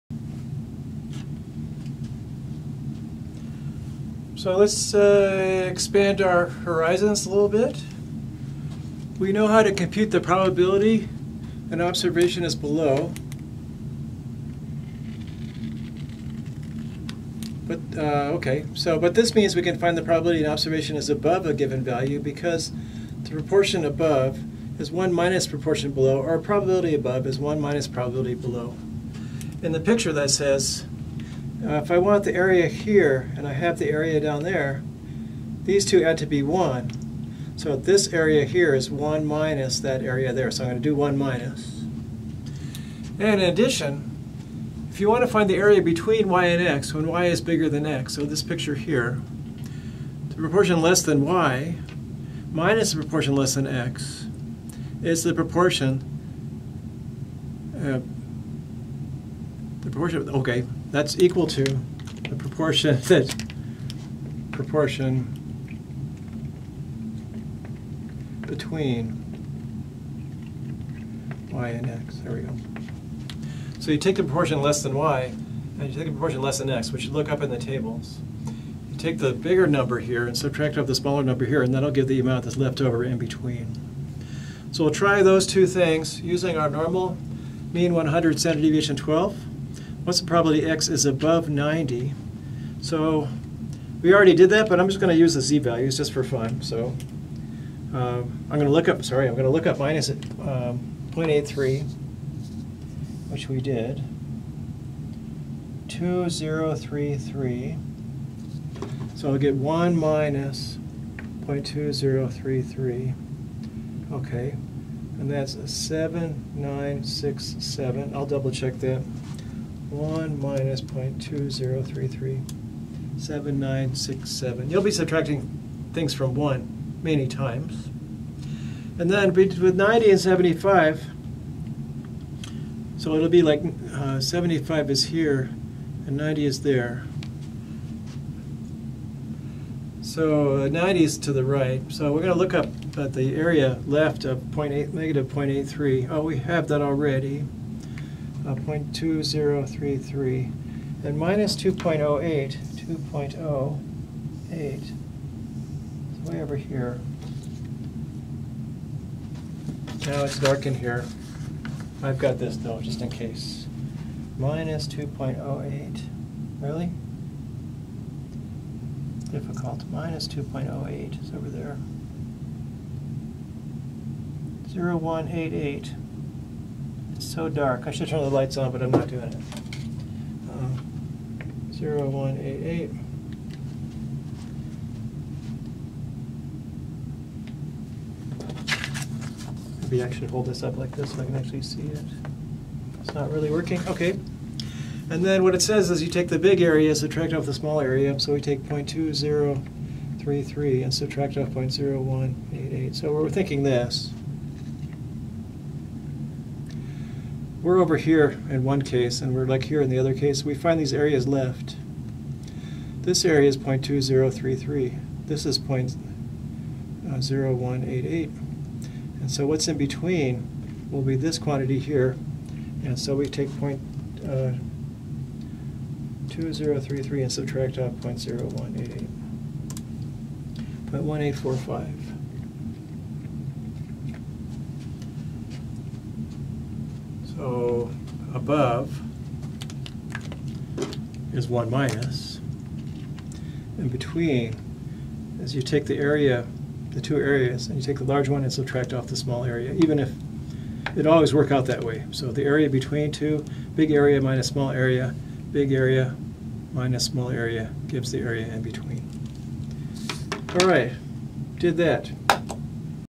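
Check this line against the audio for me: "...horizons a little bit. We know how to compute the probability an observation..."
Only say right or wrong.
right.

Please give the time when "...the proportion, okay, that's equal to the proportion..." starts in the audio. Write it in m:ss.
0:59.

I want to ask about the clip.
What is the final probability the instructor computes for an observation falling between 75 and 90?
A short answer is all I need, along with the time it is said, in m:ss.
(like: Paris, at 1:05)
0.1845, at 3:50.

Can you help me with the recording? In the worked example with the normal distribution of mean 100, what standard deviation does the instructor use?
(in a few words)
12.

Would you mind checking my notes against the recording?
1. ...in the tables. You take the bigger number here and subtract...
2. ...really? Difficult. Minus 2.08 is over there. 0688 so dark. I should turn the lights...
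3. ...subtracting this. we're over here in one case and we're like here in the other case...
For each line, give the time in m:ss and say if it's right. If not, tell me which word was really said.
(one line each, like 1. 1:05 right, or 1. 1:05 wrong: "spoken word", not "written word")
1. 1:17 right
2. 2:46 wrong: "0188", not "0688"
3. 3:23 wrong: "thinking", not "subtracting".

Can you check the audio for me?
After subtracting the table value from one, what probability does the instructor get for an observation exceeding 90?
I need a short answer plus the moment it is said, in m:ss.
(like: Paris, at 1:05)
0.7967, at 1:55.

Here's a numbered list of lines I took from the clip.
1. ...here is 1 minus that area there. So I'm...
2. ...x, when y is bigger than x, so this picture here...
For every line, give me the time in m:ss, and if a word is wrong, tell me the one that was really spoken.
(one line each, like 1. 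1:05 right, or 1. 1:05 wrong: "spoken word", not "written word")
1. 0:38 right
2. 0:46 right.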